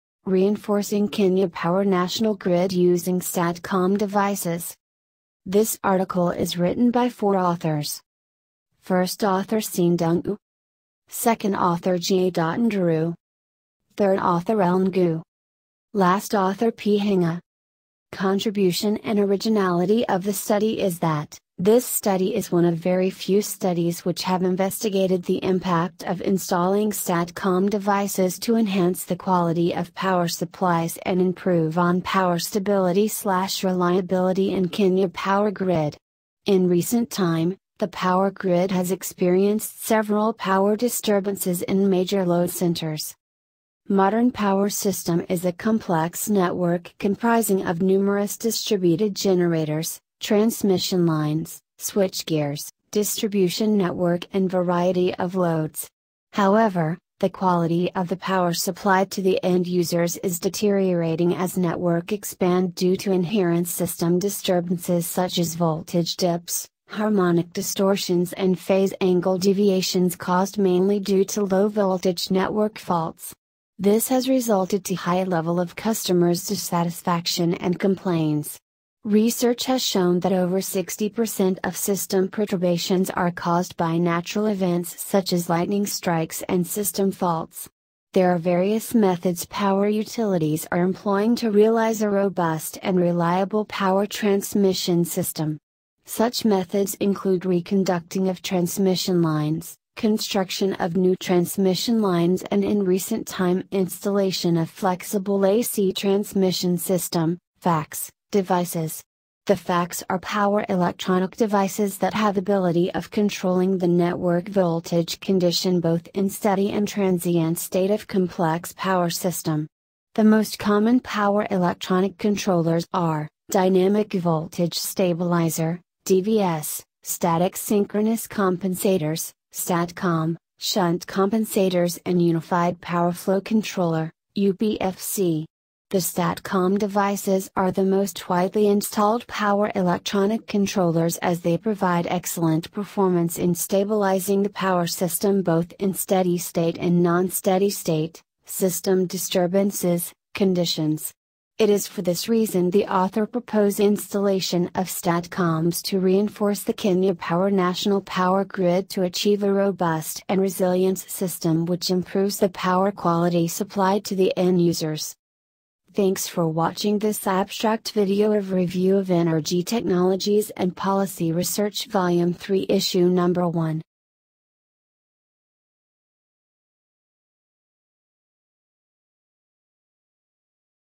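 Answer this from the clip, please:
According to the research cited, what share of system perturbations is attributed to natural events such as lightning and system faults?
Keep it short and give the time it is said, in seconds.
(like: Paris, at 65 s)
over 60%, at 80 s.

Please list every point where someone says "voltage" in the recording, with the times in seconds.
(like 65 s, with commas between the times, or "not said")
65 s, 71 s, 114 s, 124 s.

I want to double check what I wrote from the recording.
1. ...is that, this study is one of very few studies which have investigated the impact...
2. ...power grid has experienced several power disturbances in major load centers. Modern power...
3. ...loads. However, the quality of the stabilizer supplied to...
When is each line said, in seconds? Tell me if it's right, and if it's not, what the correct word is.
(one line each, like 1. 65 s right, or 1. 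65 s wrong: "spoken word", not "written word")
1. 20 s right
2. 37 s right
3. 55 s wrong: "power", not "stabilizer".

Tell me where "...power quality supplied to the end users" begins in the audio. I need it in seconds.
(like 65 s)
162 s.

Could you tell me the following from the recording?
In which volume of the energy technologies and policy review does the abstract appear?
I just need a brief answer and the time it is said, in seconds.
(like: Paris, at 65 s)
3, at 171 s.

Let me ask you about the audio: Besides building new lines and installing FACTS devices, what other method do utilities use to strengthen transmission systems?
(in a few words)
reconducting of transmission lines.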